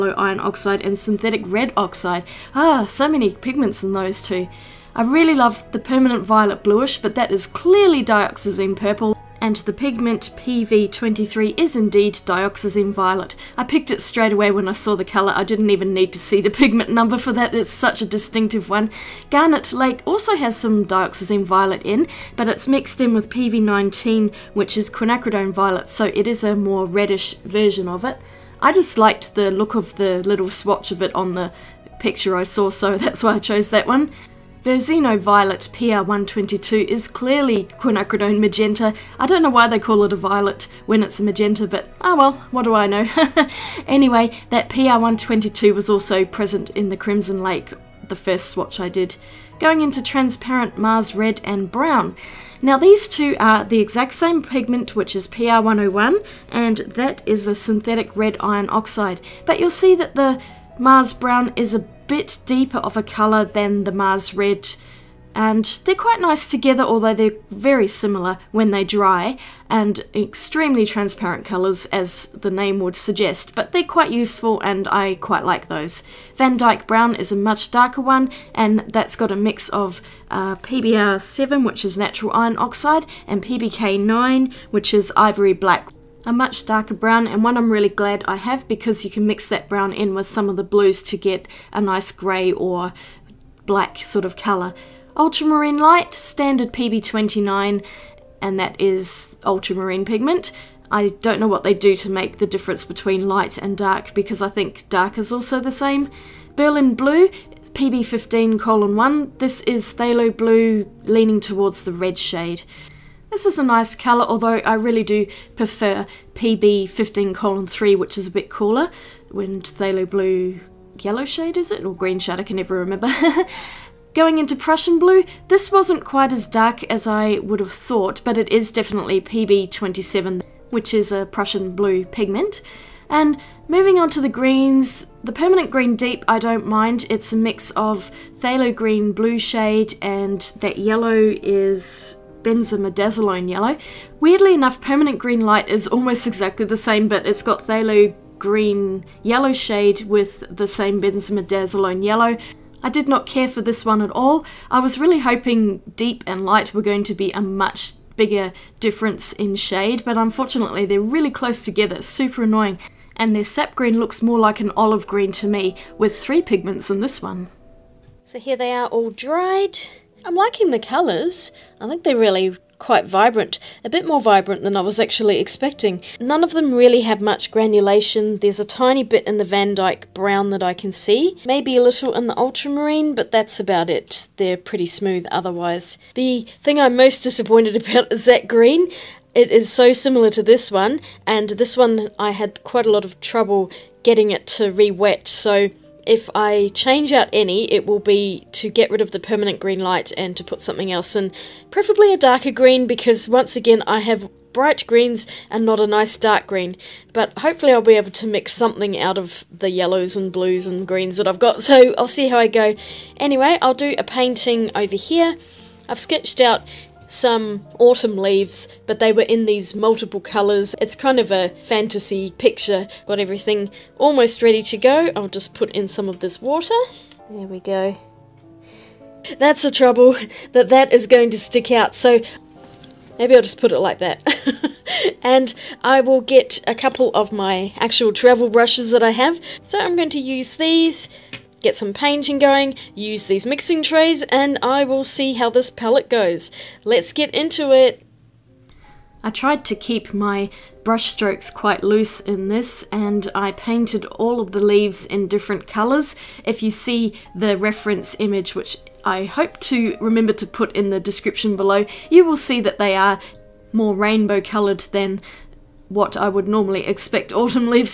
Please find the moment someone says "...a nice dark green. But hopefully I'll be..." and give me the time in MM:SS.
03:25.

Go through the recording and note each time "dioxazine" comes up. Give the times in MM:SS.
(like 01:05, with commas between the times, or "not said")
00:08, 00:12, 00:20.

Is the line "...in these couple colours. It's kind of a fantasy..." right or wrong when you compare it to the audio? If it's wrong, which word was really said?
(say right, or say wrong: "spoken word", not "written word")
wrong: "multiple", not "couple".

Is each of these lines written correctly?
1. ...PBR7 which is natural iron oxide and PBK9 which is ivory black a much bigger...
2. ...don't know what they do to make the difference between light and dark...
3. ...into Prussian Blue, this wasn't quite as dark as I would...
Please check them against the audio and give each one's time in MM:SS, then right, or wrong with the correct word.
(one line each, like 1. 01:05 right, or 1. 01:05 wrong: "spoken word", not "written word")
1. 01:20 wrong: "darker", not "bigger"
2. 01:41 right
3. 02:04 right.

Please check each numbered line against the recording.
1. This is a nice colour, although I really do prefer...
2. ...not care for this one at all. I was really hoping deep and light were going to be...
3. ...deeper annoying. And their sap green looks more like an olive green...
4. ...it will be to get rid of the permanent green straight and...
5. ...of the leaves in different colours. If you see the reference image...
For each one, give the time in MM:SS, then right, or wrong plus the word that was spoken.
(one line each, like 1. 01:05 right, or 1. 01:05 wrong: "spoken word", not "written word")
1. 01:53 right
2. 02:33 right
3. 02:42 wrong: "super", not "deeper"
4. 03:17 wrong: "light", not "straight"
5. 04:14 right.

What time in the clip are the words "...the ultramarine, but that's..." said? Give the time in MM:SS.
03:02.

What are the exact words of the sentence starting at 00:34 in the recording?
The Violet PR122 is clearly quinacridone magenta.